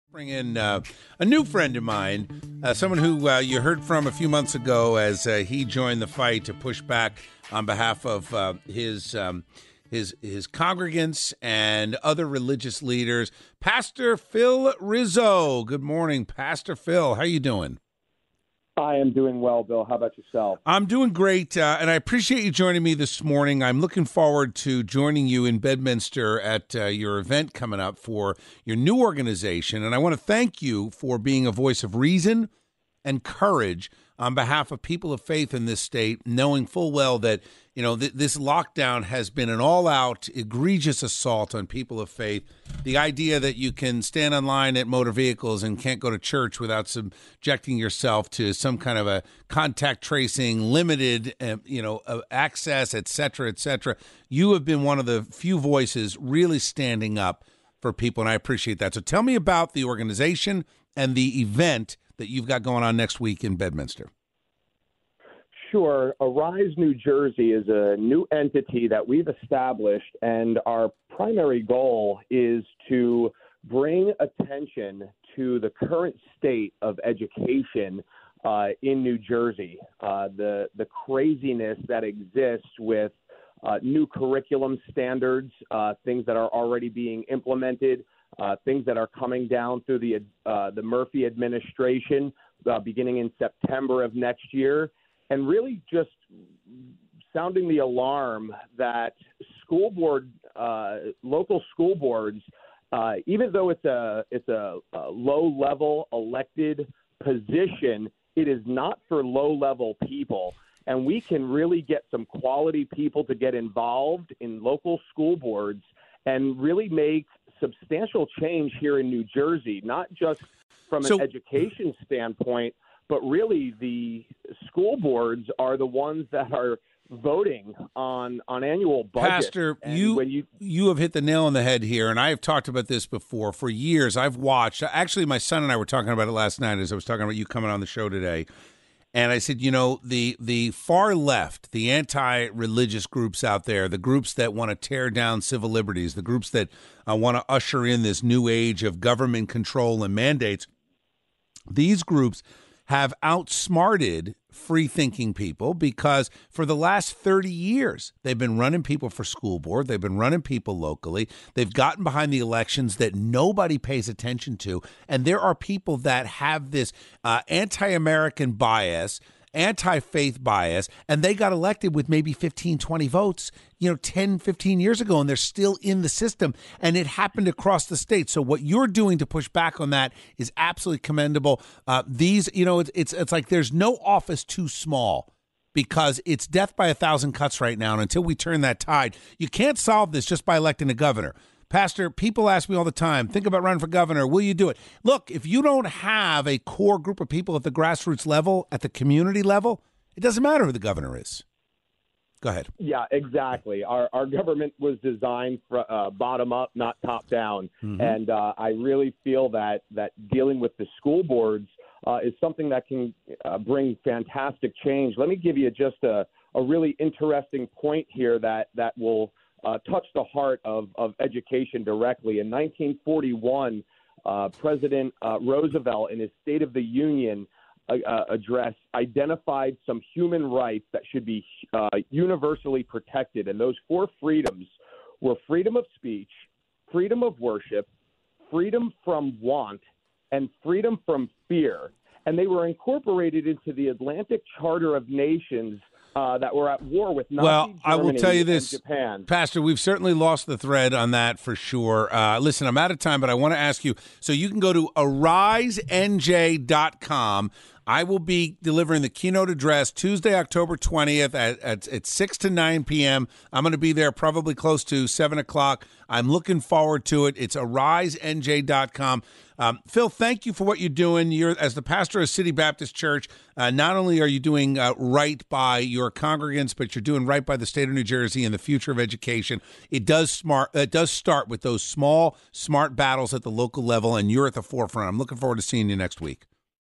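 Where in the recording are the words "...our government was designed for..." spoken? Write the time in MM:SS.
03:24.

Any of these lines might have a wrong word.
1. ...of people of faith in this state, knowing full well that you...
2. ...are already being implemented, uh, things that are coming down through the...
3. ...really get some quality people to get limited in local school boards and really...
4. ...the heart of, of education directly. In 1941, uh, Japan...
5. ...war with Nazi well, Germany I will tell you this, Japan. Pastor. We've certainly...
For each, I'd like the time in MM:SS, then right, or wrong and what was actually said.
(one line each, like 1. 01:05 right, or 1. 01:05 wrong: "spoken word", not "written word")
1. 00:34 right
2. 01:26 right
3. 01:51 wrong: "involved", not "limited"
4. 03:40 wrong: "President", not "Japan"
5. 04:06 right.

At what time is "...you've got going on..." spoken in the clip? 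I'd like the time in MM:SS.
01:02.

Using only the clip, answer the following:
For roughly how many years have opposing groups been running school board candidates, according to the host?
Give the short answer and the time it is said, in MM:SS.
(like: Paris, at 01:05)
30 years, at 02:37.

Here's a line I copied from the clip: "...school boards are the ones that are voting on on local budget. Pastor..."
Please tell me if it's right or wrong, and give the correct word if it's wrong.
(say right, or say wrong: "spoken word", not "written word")
wrong: "annual", not "local".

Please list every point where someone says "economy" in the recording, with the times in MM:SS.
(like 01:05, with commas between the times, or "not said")
not said.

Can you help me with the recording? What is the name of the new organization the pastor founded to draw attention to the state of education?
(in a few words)
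Arise New Jersey.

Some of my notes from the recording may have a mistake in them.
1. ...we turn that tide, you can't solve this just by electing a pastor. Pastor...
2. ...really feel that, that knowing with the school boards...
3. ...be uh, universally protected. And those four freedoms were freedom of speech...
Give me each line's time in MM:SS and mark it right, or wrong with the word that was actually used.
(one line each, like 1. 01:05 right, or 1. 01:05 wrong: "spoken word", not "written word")
1. 03:08 wrong: "governor", not "pastor"
2. 03:28 wrong: "dealing", not "knowing"
3. 03:51 right.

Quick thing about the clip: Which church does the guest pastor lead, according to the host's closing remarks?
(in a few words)
City Baptist Church.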